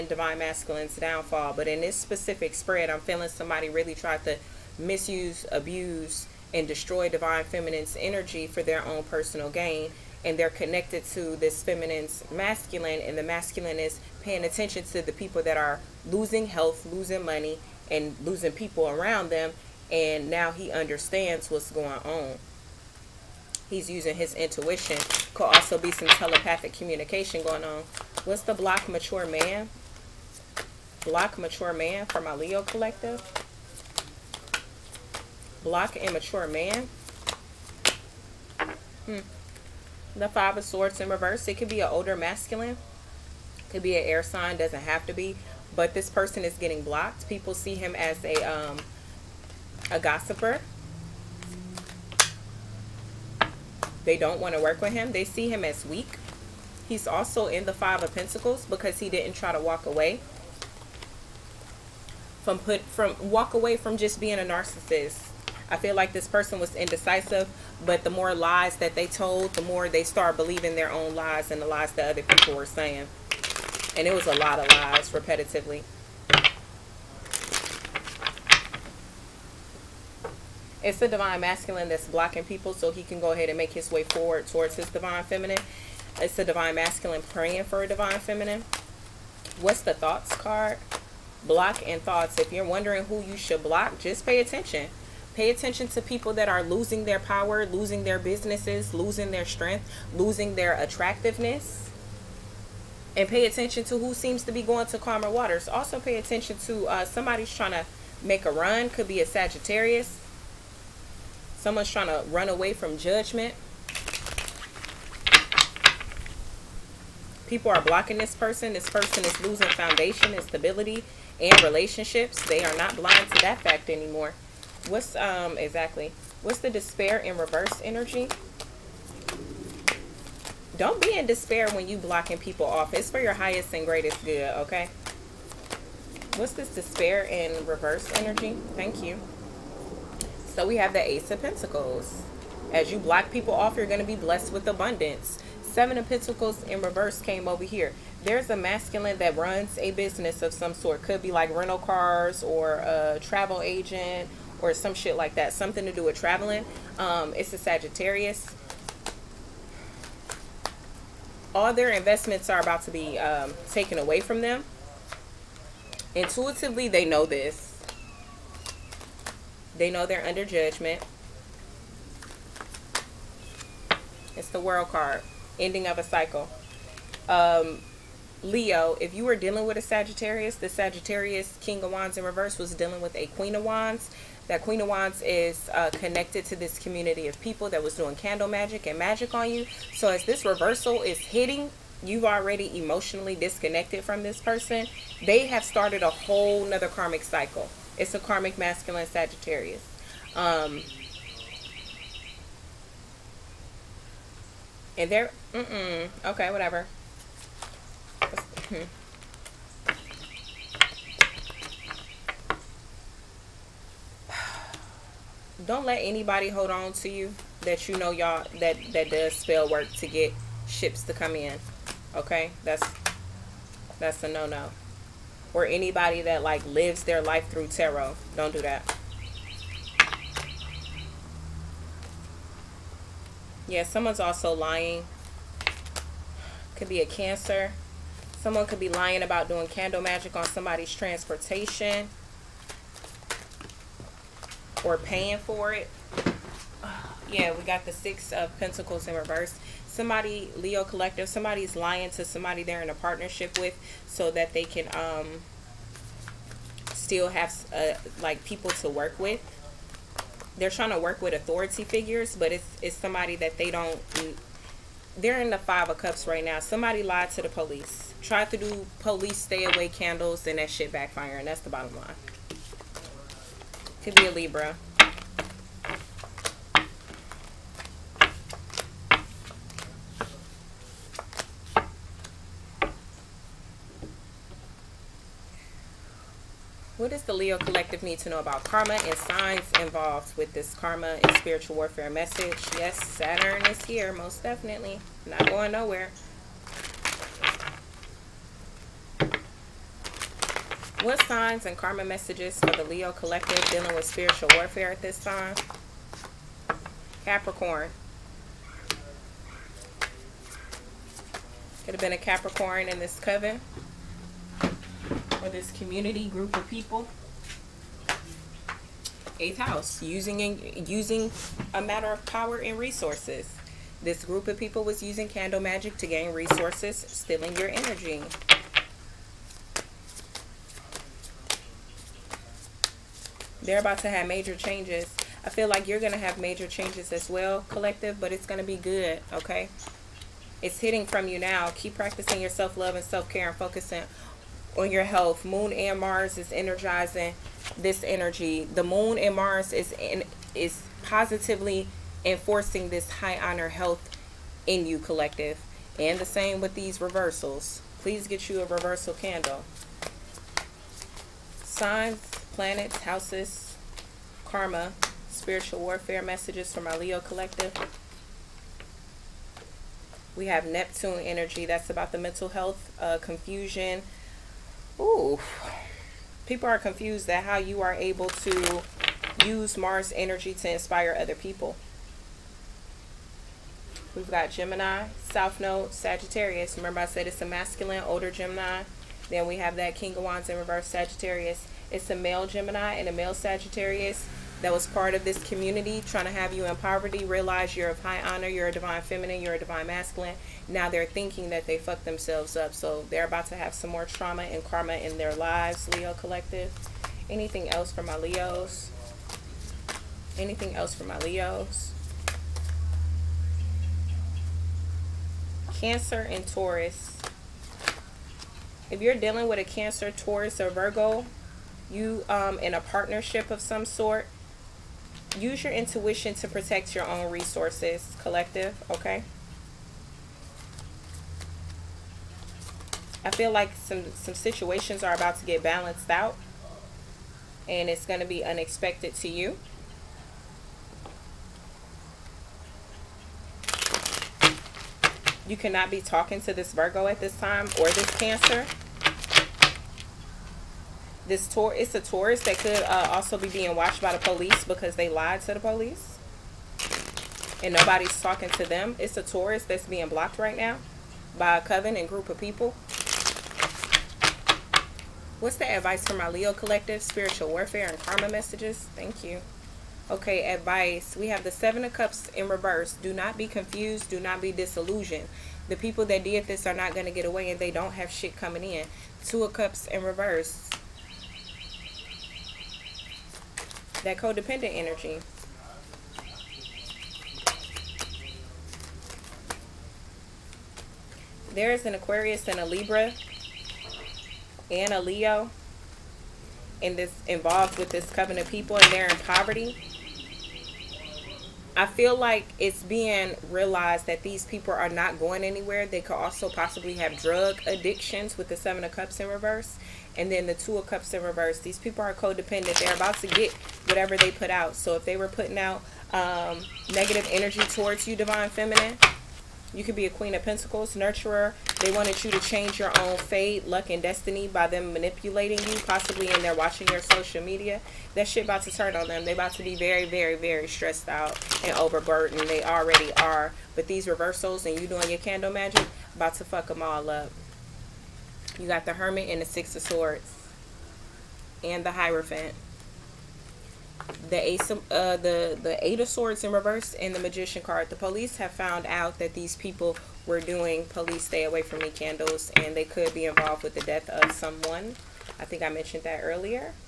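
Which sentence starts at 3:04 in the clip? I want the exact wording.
That Queen of Wands is uh, connected to this community of people that was doing candle magic and magic on you.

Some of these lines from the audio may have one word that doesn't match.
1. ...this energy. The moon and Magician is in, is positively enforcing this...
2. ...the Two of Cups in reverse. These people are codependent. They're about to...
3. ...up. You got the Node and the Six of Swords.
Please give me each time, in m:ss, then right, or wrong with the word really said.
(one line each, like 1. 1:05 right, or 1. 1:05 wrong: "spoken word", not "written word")
1. 5:47 wrong: "Mars", not "Magician"
2. 8:30 right
3. 8:57 wrong: "Hermit", not "Node".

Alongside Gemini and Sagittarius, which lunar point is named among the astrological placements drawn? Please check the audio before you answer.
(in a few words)
South Node.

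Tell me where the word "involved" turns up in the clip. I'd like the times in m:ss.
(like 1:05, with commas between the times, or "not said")
4:49, 8:17, 9:13.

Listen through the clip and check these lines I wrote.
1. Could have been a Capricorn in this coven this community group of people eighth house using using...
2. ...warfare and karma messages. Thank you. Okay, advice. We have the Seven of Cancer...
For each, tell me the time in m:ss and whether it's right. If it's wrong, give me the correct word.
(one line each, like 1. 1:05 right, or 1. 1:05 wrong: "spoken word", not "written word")
1. 5:11 right
2. 7:47 wrong: "Cups", not "Cancer".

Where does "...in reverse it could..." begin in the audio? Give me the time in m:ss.
0:40.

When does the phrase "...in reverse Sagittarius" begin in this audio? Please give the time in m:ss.
6:30.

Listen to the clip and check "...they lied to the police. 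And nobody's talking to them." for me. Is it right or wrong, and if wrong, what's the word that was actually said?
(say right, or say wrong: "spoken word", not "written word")
right.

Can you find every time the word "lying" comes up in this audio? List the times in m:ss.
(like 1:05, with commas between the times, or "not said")
3:54, 3:58, 4:11.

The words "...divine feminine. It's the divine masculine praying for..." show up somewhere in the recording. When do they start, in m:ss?
1:24.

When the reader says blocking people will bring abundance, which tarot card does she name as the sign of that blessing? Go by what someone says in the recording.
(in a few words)
Ace of Pentacles.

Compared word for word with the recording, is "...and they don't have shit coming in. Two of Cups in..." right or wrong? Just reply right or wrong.
right.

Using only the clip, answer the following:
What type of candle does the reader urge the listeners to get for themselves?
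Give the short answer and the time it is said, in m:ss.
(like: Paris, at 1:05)
A reversal candle, at 5:58.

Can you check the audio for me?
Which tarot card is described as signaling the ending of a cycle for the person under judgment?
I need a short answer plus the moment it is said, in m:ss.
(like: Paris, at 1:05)
The World, at 2:54.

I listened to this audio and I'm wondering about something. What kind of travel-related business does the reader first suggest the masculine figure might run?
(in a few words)
Rental cars.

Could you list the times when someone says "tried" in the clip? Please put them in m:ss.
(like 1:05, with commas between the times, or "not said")
0:03, 4:28.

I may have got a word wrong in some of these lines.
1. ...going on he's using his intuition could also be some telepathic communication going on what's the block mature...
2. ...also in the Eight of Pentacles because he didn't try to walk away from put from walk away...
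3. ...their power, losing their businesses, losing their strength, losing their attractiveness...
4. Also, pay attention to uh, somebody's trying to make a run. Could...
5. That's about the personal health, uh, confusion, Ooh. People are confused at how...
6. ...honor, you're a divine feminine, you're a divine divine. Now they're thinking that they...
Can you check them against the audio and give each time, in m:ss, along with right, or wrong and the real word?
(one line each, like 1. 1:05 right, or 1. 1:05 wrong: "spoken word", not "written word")
1. 0:21 right
2. 0:57 wrong: "Five", not "Eight"
3. 1:37 right
4. 1:45 right
5. 6:11 wrong: "mental", not "personal"
6. 6:38 wrong: "masculine", not "divine".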